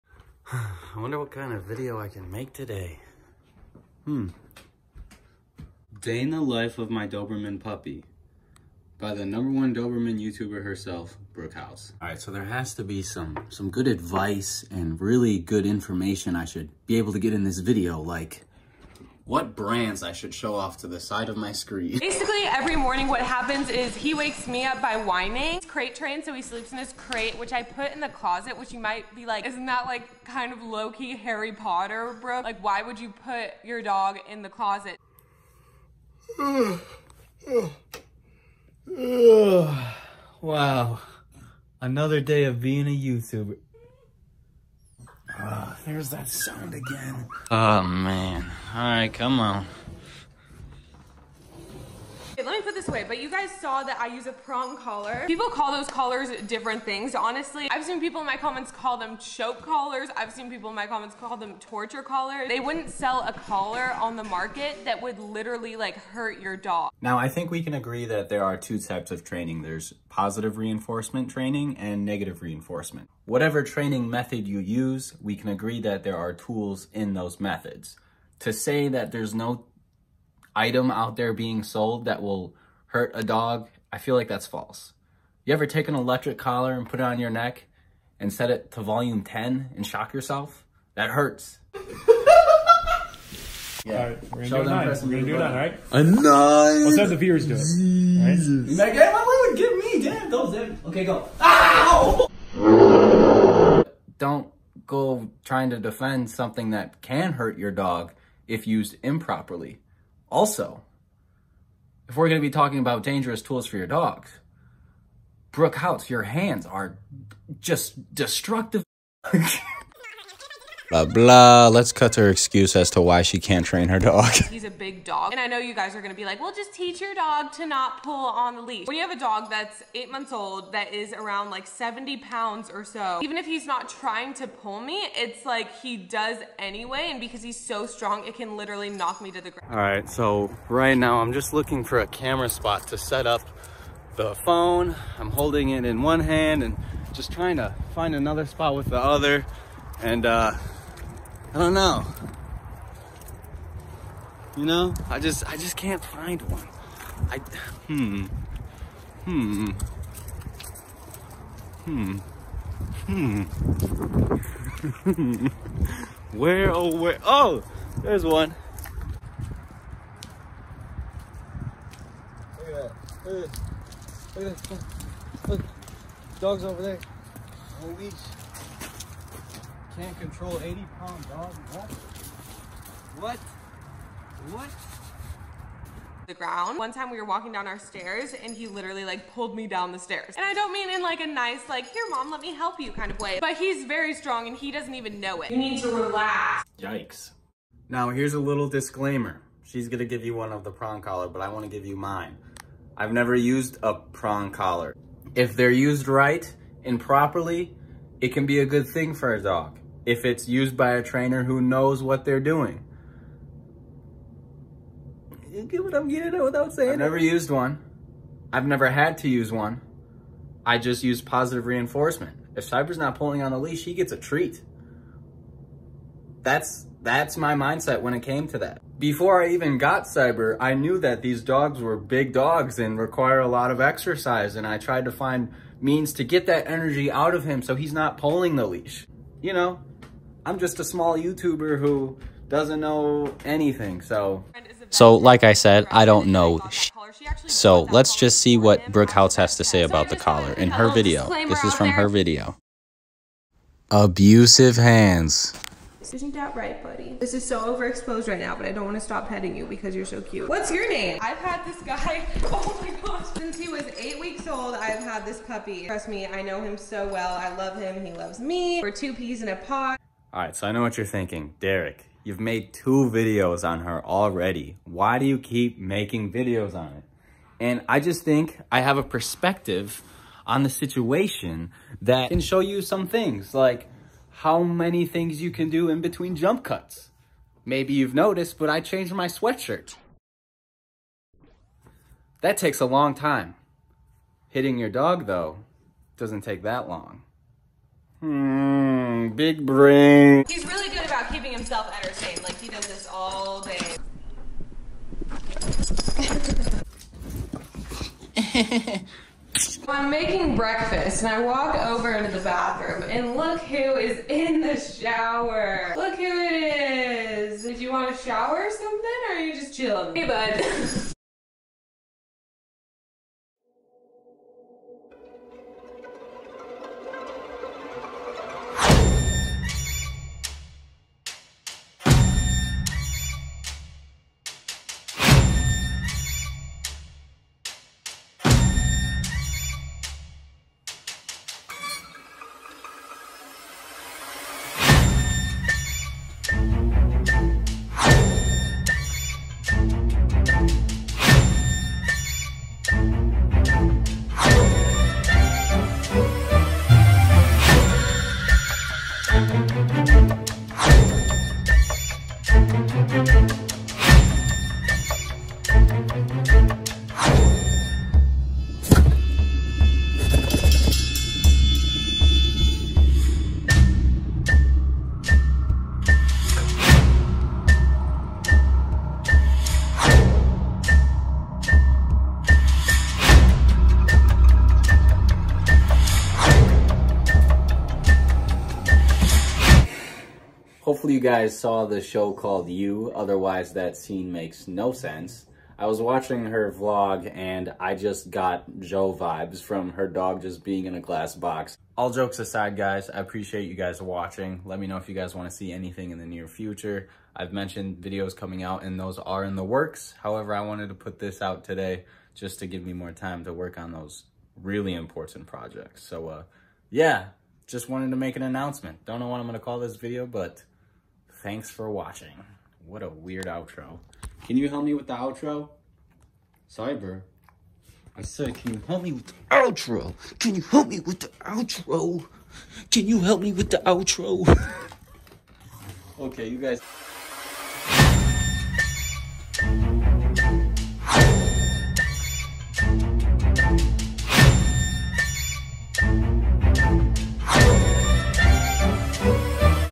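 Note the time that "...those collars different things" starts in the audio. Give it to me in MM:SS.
00:55.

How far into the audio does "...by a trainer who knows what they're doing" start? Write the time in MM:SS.
03:30.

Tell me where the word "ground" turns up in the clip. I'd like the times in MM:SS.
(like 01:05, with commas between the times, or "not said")
02:19, 03:06.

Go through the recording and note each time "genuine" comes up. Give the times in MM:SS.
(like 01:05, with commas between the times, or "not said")
not said.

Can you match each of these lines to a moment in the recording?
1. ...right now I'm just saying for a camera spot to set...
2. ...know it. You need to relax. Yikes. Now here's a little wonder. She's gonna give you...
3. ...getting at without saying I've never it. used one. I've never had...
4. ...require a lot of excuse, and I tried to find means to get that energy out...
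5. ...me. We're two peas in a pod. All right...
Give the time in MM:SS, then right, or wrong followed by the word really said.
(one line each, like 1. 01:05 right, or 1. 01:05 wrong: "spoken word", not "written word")
1. 02:20 wrong: "looking", not "saying"
2. 03:15 wrong: "disclaimer", not "wonder"
3. 03:36 right
4. 03:52 wrong: "exercise", not "excuse"
5. 04:28 right.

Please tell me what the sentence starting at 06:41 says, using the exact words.
All jokes aside, guys, I appreciate you guys watching.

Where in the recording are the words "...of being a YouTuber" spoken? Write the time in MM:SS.
00:42.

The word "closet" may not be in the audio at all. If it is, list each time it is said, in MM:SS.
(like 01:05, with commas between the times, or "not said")
00:28, 00:34.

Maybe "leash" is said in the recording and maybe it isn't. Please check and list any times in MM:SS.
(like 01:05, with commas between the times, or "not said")
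02:08, 03:43, 03:58.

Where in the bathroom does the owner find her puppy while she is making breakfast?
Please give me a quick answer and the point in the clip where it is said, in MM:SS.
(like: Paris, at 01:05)
In the shower, at 05:14.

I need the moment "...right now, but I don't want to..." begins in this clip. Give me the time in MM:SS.
04:18.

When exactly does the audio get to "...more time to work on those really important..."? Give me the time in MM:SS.
06:52.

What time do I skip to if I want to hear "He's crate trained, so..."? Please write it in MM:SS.
00:25.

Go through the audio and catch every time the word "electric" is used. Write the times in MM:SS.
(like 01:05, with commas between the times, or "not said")
01:25.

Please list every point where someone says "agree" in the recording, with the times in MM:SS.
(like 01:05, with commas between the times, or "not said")
01:07, 01:15.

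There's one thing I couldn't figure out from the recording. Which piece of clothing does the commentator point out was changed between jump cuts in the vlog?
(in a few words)
Sweatshirt.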